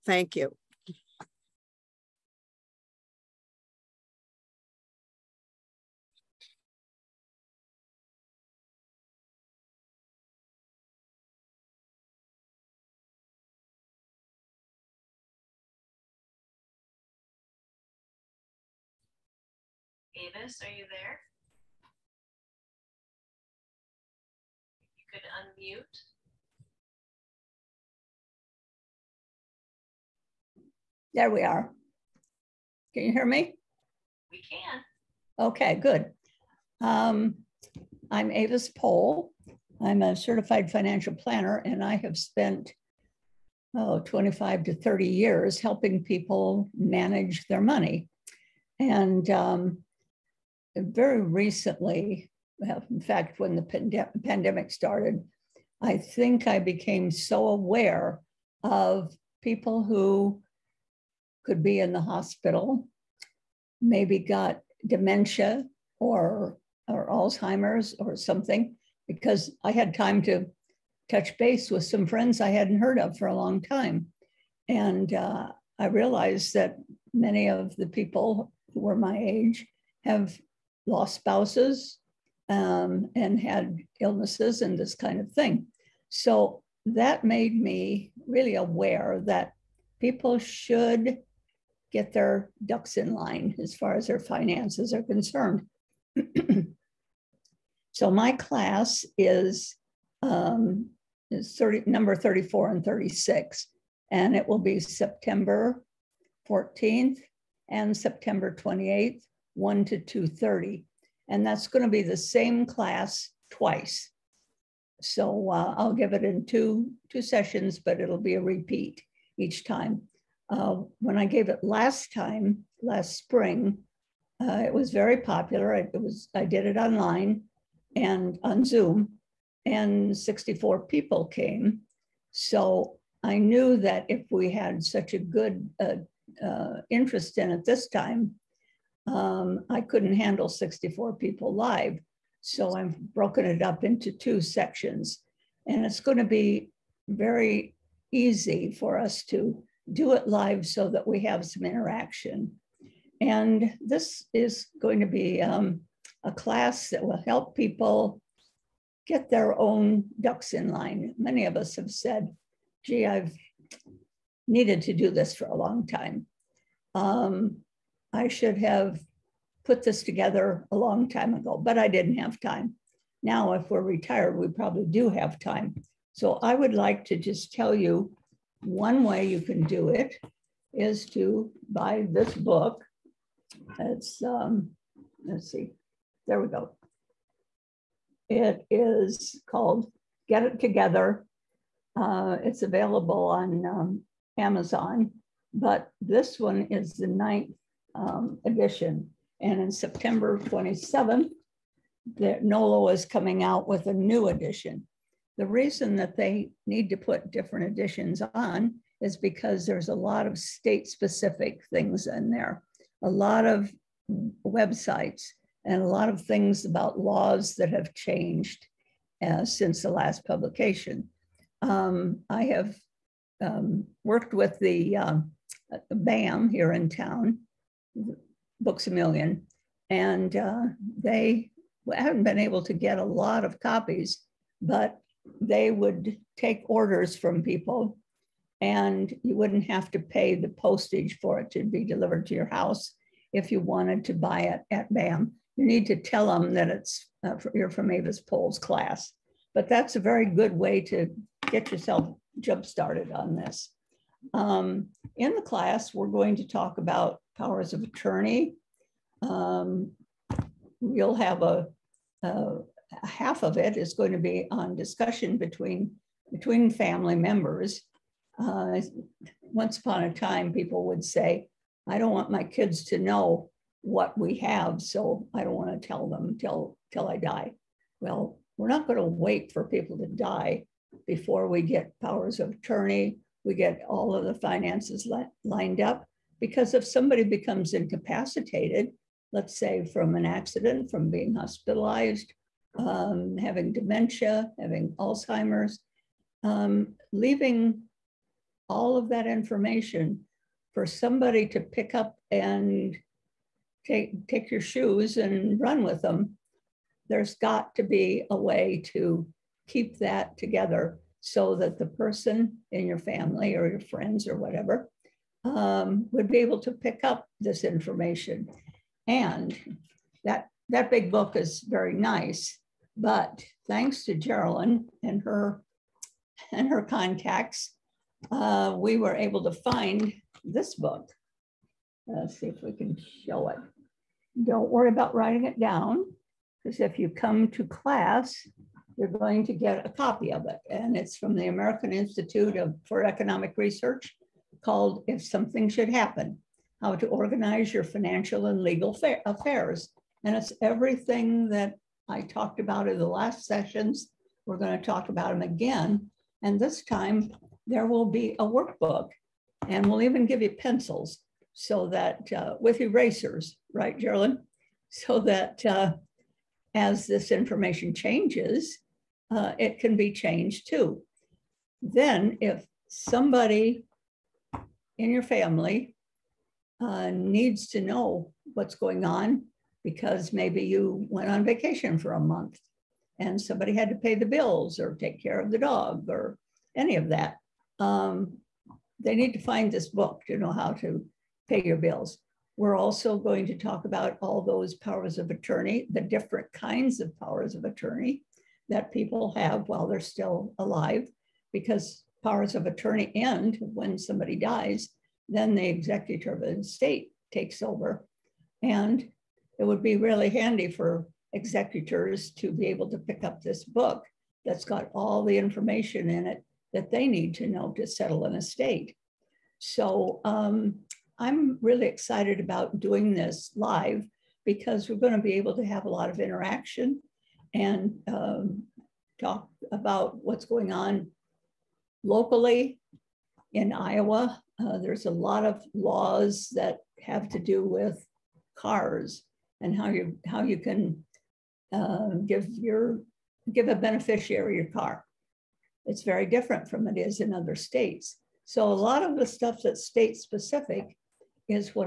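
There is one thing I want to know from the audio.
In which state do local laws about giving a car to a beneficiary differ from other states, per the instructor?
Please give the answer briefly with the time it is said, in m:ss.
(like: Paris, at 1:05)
Iowa, at 7:13.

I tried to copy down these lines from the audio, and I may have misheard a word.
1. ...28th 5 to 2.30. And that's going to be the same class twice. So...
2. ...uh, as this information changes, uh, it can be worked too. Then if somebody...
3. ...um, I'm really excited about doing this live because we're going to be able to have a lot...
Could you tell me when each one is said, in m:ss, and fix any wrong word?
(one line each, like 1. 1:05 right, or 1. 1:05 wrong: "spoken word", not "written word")
1. 1:48 wrong: "1", not "5"
2. 6:05 wrong: "changed", not "worked"
3. 7:00 right.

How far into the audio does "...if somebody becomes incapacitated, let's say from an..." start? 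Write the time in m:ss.
4:46.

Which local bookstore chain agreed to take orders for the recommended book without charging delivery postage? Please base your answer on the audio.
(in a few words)
Books a Million.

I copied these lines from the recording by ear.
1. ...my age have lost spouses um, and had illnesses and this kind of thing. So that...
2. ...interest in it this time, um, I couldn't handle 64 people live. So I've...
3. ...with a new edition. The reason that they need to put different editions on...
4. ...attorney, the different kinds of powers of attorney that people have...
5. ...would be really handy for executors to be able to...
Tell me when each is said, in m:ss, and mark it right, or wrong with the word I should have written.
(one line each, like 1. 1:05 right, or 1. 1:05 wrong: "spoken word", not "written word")
1. 1:18 right
2. 2:16 right
3. 3:23 right
4. 6:35 right
5. 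6:49 right.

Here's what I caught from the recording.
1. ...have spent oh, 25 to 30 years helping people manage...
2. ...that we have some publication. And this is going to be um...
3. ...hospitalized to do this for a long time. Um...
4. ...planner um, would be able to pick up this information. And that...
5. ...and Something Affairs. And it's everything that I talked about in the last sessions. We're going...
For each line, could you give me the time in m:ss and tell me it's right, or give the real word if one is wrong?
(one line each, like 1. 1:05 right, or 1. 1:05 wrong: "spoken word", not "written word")
1. 0:41 right
2. 2:30 wrong: "interaction", not "publication"
3. 2:44 wrong: "needed", not "hospitalized"
4. 5:14 wrong: "whatever", not "planner"
5. 5:48 wrong: "Legal", not "Something".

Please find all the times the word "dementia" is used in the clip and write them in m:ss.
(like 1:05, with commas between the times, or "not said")
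1:04, 4:53.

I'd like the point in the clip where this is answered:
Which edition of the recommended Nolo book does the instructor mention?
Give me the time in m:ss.
3:17.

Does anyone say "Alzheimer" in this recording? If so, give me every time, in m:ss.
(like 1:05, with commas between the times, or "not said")
1:07, 4:54.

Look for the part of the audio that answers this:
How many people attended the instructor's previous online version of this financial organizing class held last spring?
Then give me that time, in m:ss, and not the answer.
2:10.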